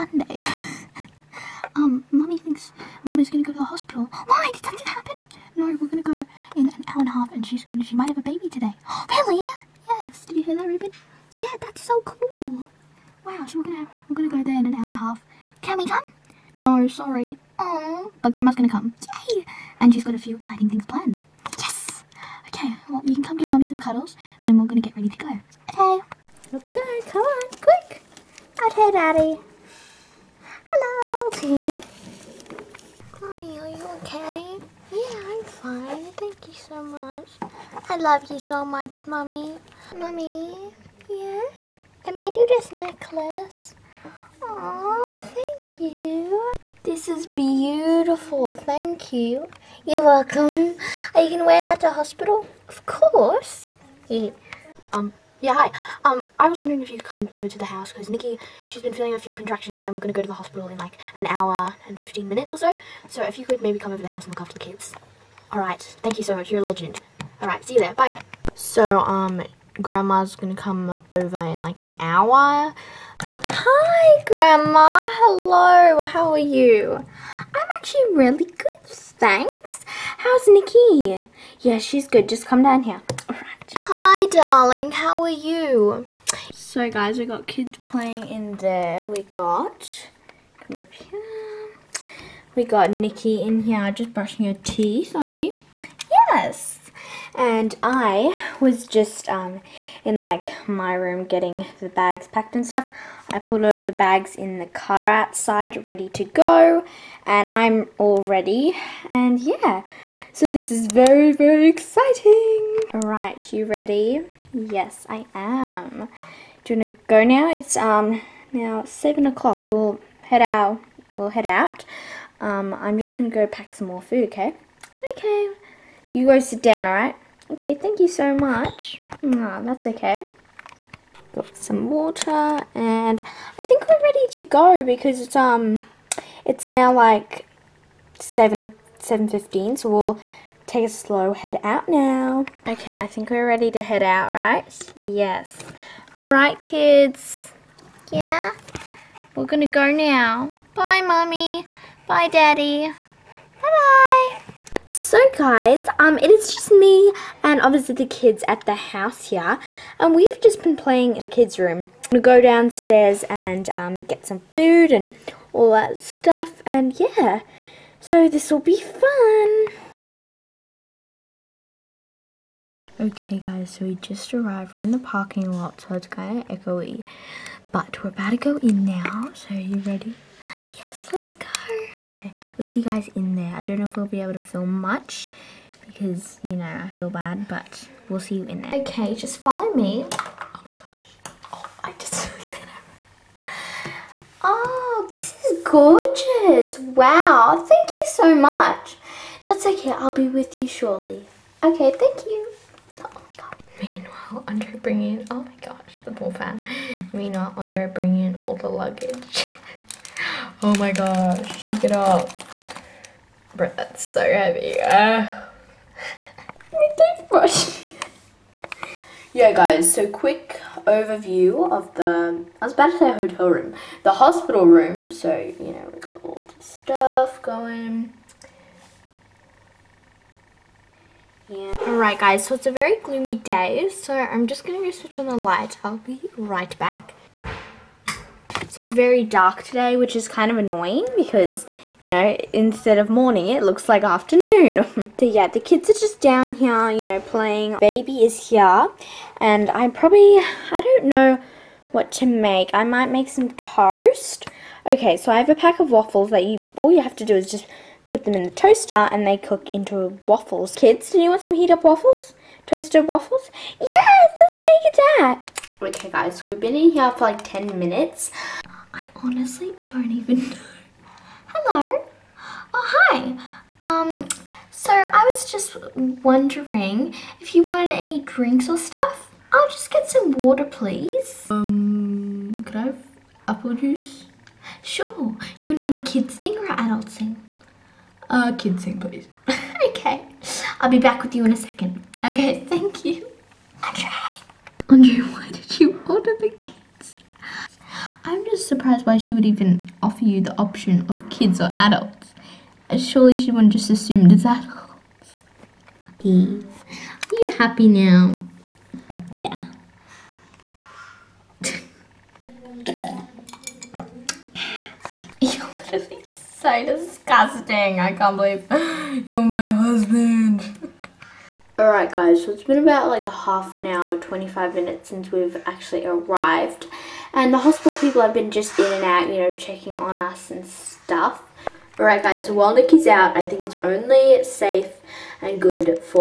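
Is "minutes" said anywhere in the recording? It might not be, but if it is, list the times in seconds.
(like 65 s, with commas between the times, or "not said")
62 s, 267 s, 324 s.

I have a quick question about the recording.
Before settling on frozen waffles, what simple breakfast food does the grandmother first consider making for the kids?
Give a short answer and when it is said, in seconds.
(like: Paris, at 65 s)
toast, at 253 s.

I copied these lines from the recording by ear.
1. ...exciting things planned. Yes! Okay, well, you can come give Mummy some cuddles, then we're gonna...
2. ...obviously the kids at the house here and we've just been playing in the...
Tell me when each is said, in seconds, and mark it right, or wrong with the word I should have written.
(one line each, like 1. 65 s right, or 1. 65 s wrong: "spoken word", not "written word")
1. 20 s right
2. 157 s right.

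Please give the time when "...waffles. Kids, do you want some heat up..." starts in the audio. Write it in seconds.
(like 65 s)
260 s.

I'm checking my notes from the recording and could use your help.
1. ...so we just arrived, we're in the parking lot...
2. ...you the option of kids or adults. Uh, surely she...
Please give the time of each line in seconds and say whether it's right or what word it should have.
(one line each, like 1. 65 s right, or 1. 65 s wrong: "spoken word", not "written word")
1. 173 s right
2. 300 s right.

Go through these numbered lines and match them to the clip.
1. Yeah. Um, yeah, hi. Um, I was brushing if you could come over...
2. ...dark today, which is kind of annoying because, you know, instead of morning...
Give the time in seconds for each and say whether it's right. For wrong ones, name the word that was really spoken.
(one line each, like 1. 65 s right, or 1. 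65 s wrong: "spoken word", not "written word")
1. 54 s wrong: "wondering", not "brushing"
2. 239 s right.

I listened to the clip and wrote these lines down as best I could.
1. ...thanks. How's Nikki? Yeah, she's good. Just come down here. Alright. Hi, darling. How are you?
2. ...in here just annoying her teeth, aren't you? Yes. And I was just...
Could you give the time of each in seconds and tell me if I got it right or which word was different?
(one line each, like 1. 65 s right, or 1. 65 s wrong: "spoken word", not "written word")
1. 78 s right
2. 93 s wrong: "brushing", not "annoying".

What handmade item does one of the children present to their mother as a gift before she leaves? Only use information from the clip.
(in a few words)
necklace.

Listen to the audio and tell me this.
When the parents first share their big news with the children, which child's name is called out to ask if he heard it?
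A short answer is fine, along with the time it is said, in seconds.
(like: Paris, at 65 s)
Ruben, at 10 s.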